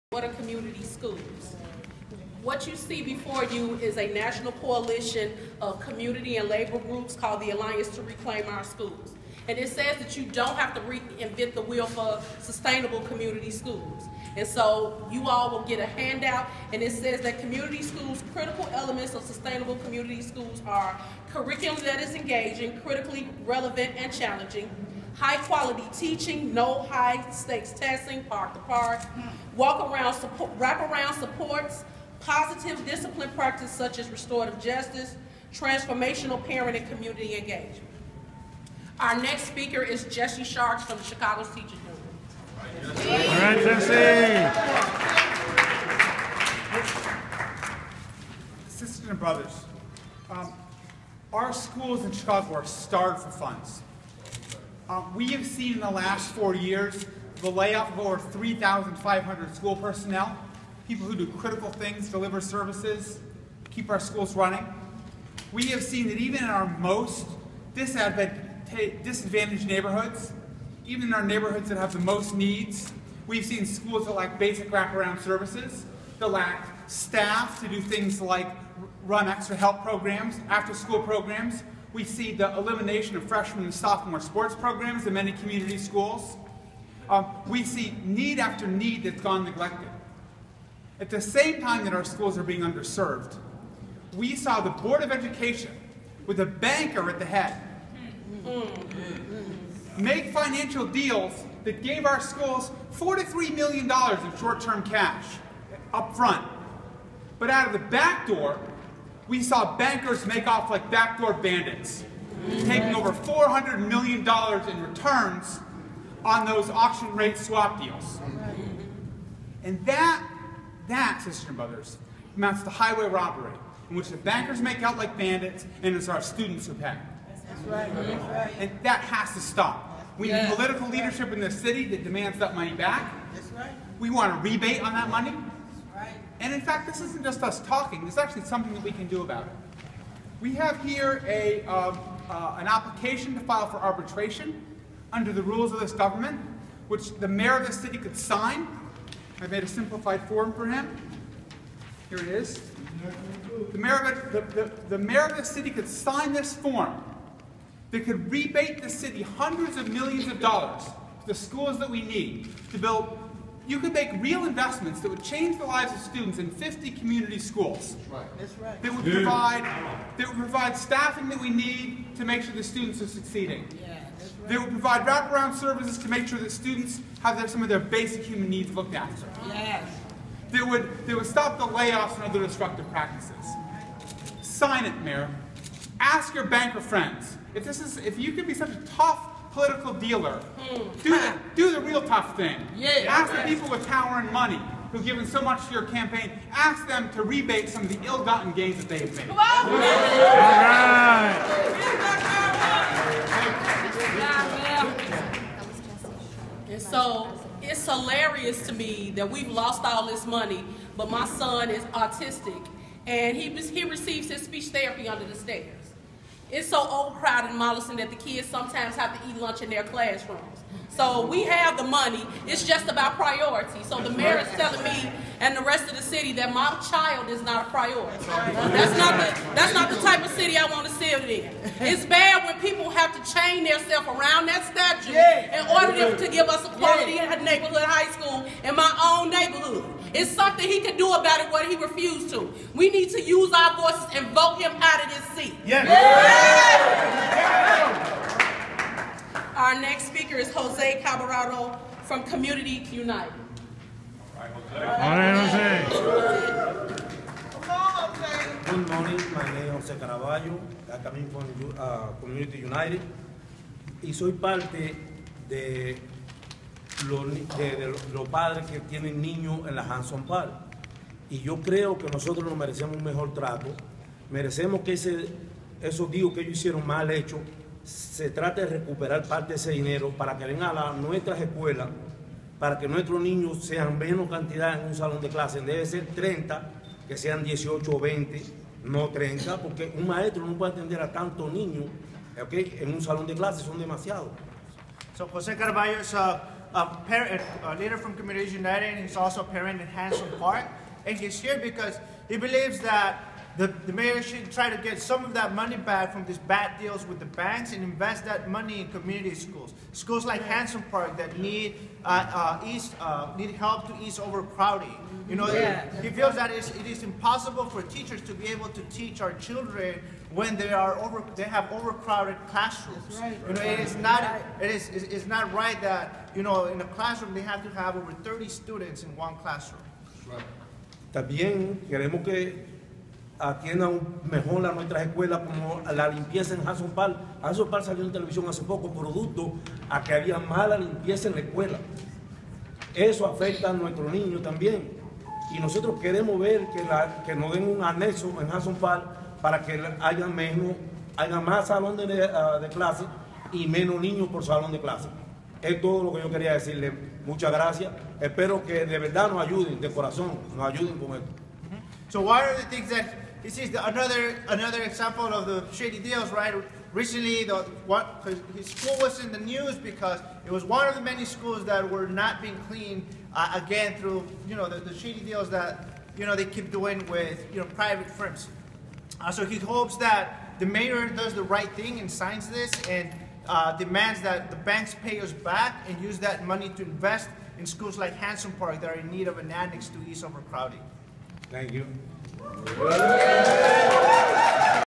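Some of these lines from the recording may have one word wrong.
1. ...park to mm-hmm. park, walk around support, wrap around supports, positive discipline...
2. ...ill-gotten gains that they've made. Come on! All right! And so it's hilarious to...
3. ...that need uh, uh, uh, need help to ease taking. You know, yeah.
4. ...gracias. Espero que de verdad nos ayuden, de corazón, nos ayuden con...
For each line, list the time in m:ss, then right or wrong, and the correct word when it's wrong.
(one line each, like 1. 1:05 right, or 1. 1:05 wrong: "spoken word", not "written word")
1. 0:28 right
2. 3:18 right
3. 5:11 wrong: "overcrowding", not "taking"
4. 5:57 right.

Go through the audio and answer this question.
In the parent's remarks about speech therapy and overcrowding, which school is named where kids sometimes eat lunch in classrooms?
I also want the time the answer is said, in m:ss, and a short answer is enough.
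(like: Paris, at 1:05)
Mollison, at 3:37.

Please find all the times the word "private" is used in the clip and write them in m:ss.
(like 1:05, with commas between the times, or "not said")
6:17.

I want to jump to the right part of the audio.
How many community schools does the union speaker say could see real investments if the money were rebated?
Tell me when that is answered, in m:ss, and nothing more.
2:46.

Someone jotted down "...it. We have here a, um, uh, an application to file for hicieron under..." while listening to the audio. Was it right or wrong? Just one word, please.
wrong.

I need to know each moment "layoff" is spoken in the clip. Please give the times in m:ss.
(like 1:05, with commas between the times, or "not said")
0:57, 3:01.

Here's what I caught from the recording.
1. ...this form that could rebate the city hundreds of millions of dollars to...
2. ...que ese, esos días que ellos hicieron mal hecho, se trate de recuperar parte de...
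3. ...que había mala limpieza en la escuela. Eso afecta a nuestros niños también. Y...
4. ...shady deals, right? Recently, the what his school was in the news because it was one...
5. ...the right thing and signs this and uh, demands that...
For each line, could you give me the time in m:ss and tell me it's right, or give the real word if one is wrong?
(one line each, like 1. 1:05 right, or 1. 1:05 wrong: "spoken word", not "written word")
1. 2:36 right
2. 4:34 right
3. 5:40 right
4. 6:05 right
5. 6:21 right.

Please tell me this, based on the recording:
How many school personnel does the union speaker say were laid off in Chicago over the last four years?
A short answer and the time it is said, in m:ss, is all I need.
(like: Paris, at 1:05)
3,500, at 0:58.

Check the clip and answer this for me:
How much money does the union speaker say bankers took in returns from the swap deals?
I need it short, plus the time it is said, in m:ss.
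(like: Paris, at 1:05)
$400 million, at 1:53.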